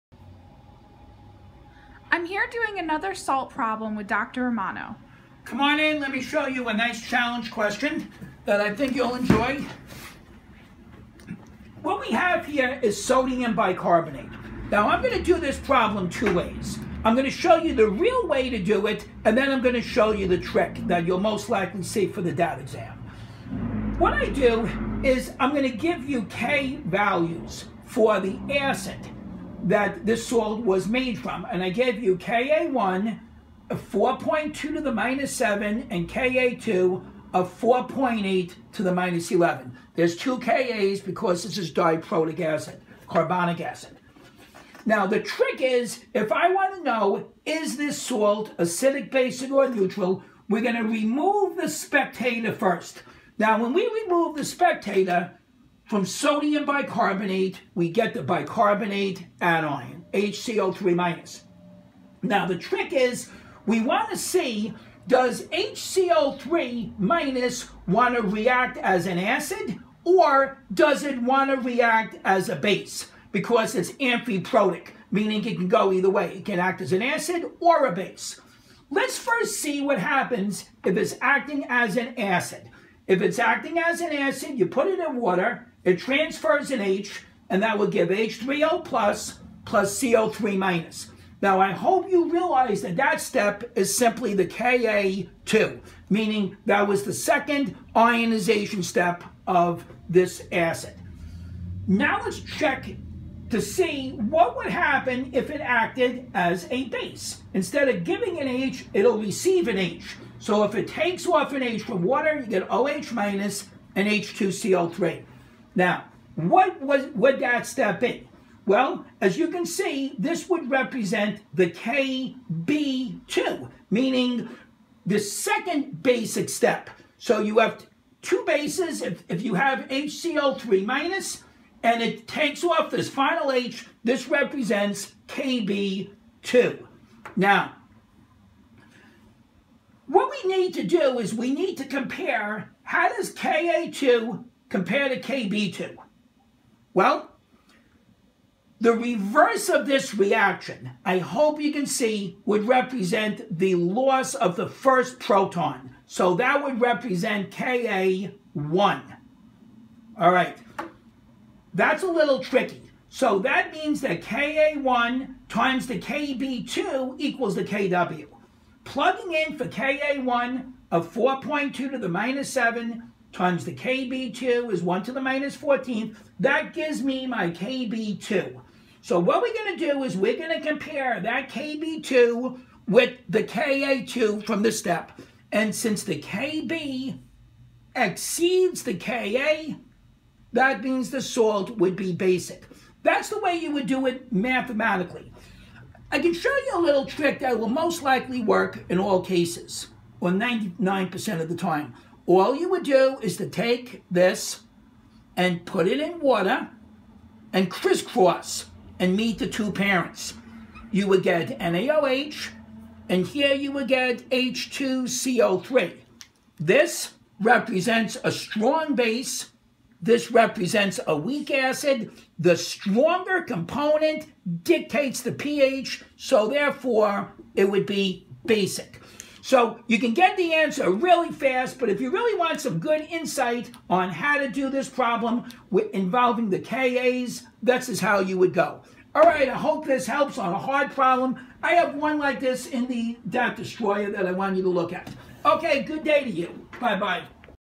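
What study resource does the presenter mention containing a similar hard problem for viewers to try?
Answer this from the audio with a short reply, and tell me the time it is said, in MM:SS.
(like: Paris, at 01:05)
DAT Destroyer, at 04:03.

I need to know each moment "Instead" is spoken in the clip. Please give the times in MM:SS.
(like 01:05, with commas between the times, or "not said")
01:47.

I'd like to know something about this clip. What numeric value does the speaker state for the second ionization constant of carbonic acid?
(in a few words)
4.8 x 10^-11.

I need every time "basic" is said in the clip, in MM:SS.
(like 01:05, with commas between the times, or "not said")
00:49, 02:06, 03:12, 03:48.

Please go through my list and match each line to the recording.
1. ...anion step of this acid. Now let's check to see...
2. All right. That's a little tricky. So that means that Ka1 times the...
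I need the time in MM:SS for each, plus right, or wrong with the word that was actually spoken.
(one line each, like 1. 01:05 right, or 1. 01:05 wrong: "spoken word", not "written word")
1. 01:37 wrong: "ionization", not "anion"
2. 02:40 right.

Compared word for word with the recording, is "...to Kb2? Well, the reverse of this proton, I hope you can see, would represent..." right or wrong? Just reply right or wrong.
wrong.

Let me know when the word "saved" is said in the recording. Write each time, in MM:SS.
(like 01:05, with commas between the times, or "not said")
not said.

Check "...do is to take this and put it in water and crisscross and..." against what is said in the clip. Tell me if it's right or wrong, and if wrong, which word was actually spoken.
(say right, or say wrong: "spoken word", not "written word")
right.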